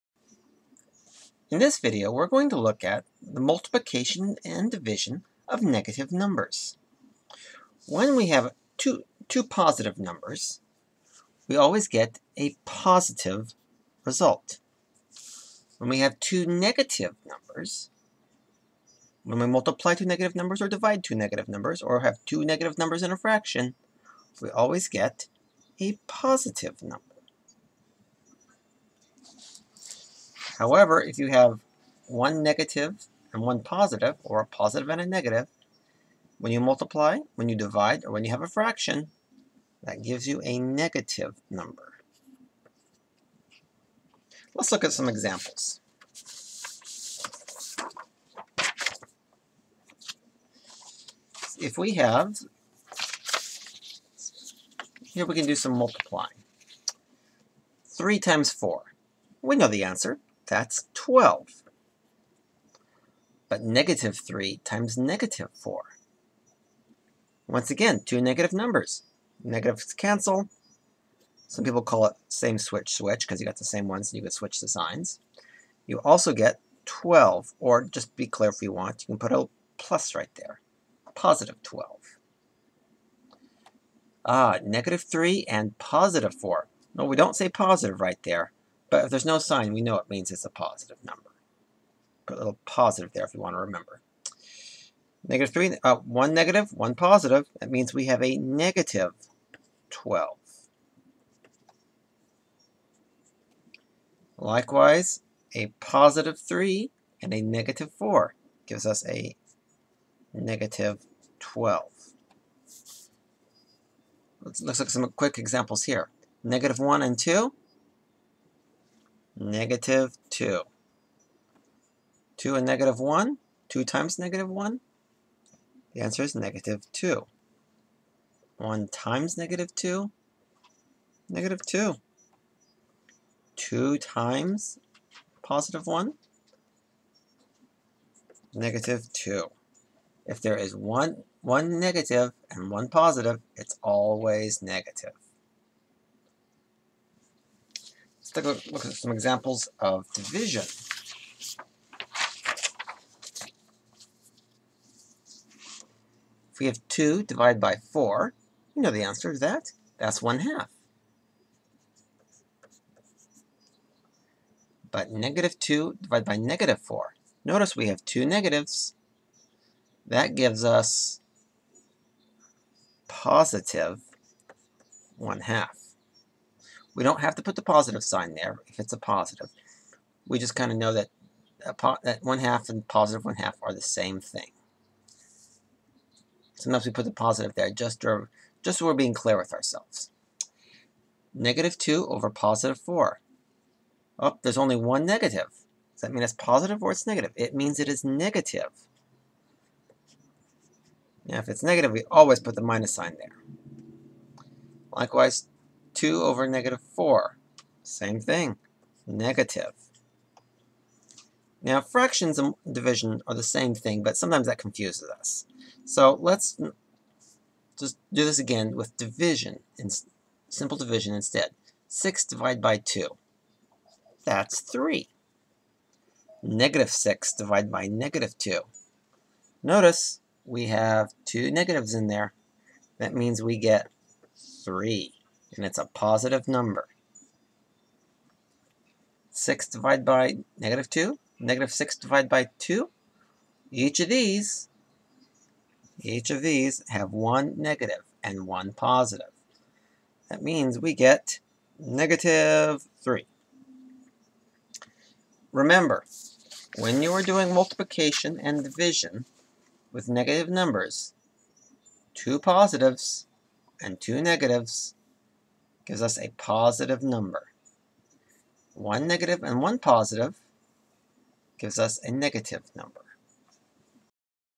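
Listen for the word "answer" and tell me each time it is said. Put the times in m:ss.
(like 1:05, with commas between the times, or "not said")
0:59, 2:06, 2:39.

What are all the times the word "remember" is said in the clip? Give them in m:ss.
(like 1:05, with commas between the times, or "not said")
1:33, 4:15.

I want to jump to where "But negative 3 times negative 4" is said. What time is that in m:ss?
1:03.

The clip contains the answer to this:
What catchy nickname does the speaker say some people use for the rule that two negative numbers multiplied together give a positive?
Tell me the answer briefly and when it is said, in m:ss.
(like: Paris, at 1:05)
same switch switch, at 1:12.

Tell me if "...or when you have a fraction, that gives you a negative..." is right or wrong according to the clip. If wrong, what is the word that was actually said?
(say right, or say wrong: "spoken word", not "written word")
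right.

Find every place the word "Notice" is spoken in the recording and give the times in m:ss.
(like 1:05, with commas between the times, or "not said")
2:47, 3:49.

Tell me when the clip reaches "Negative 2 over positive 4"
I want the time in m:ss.
3:11.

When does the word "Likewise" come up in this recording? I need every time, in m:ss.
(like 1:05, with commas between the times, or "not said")
1:44, 3:24.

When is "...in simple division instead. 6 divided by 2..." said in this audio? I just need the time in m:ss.
3:39.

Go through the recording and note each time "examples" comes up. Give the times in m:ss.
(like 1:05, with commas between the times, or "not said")
0:45, 1:55, 2:29.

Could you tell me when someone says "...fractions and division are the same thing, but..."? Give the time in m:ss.
3:31.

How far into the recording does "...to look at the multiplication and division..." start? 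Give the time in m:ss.
0:02.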